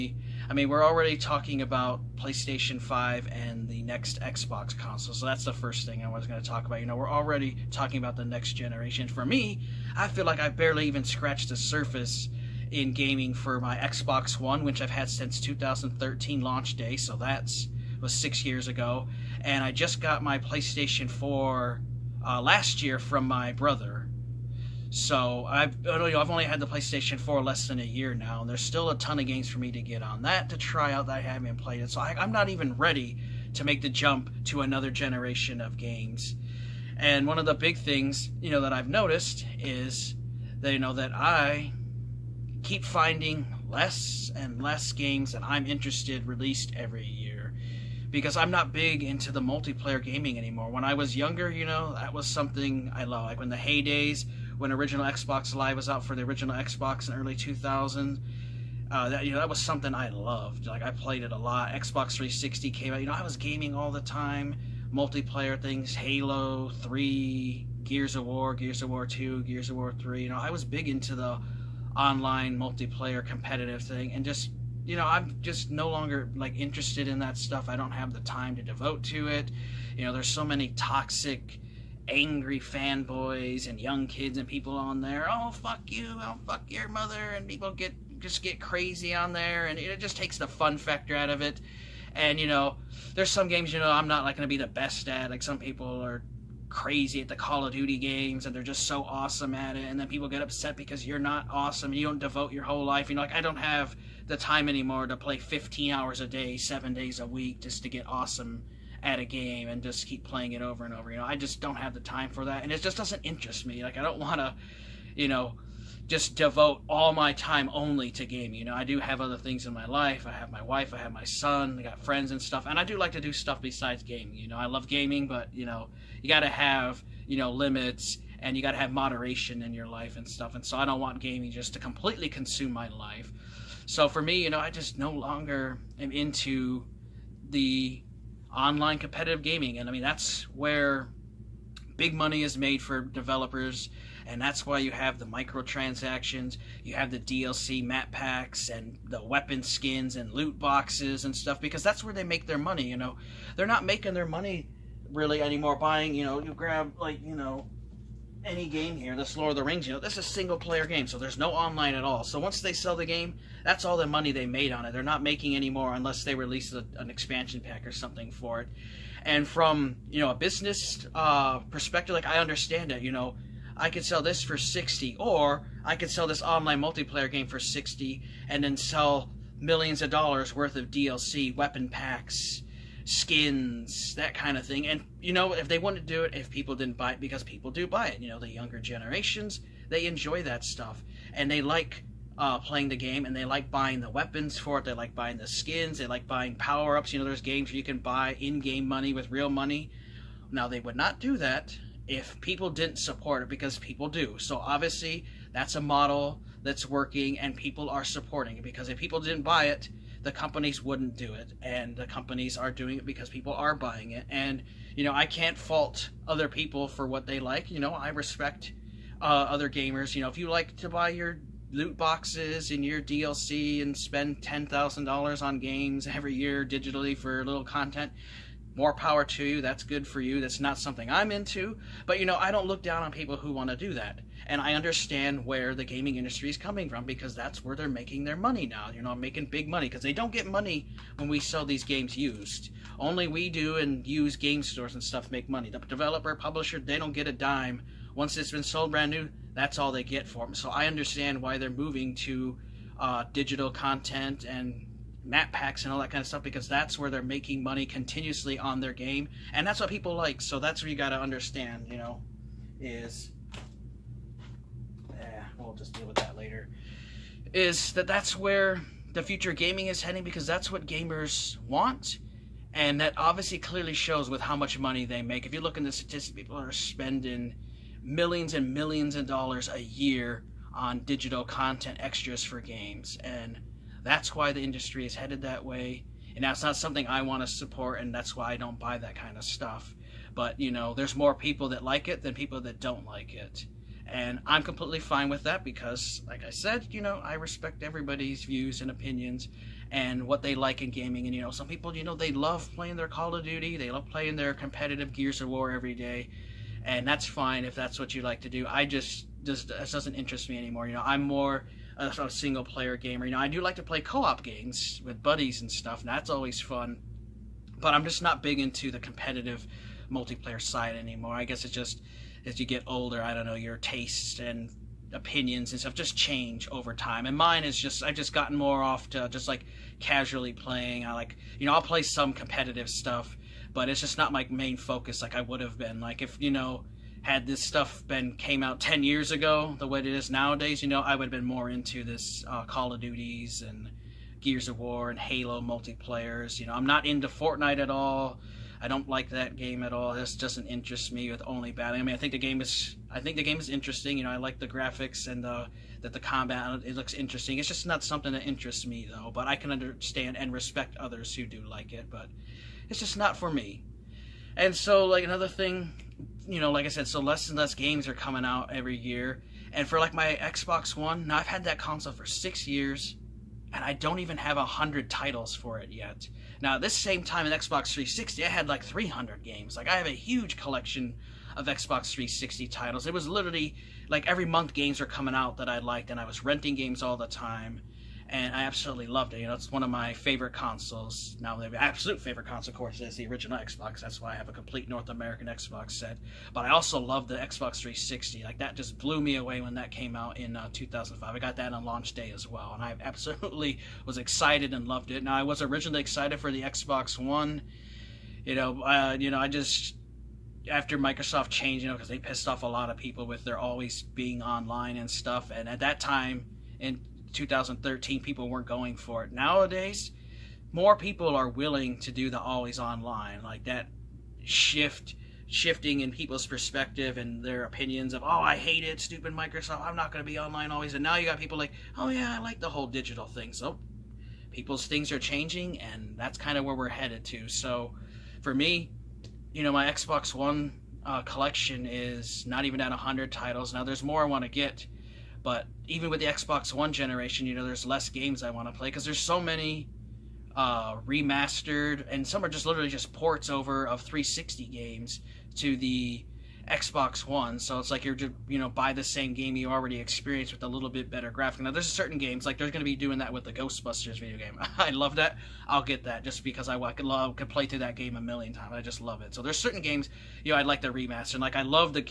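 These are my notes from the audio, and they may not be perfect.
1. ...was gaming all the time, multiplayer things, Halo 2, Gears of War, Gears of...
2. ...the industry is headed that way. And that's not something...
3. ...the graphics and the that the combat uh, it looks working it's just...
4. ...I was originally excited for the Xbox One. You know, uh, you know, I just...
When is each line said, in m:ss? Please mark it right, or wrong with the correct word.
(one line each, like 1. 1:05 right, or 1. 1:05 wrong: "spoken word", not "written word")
1. 1:03 wrong: "3", not "2"
2. 4:44 right
3. 5:54 wrong: "interesting", not "working"
4. 6:45 right.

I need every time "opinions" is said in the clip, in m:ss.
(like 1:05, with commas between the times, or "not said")
4:58, 5:25, 7:07.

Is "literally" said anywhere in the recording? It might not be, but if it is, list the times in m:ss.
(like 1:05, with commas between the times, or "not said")
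6:23, 7:32.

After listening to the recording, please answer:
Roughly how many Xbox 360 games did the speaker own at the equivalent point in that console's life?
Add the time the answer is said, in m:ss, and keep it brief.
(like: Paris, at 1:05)
300, at 6:18.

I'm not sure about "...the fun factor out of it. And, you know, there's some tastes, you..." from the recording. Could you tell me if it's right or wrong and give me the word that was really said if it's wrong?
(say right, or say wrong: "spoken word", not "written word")
wrong: "games", not "tastes".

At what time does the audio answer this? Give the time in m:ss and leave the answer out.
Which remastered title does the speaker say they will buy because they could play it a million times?
7:43.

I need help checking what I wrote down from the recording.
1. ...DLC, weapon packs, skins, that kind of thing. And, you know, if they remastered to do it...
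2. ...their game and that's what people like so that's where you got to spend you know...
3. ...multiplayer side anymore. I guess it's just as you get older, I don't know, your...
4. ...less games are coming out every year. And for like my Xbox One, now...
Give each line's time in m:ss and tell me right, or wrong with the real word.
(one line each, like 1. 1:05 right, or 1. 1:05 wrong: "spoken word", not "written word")
1. 3:00 wrong: "wanted", not "remastered"
2. 4:18 wrong: "understand", not "spend"
3. 5:20 right
4. 6:07 right.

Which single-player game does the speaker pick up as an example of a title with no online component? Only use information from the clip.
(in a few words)
Lord of the Rings.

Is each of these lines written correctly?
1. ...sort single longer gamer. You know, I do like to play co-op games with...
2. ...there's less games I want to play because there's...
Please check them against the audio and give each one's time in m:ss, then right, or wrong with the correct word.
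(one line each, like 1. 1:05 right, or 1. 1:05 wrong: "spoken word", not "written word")
1. 5:12 wrong: "player", not "longer"
2. 7:27 right.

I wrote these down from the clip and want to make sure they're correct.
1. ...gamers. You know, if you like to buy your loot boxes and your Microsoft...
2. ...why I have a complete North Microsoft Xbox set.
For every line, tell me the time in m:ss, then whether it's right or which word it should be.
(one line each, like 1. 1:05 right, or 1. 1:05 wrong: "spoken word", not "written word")
1. 3:39 wrong: "DLC", not "Microsoft"
2. 6:34 wrong: "American", not "Microsoft".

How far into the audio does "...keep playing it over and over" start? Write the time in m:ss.
1:50.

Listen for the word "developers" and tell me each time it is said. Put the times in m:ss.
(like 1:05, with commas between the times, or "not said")
2:22, 4:05.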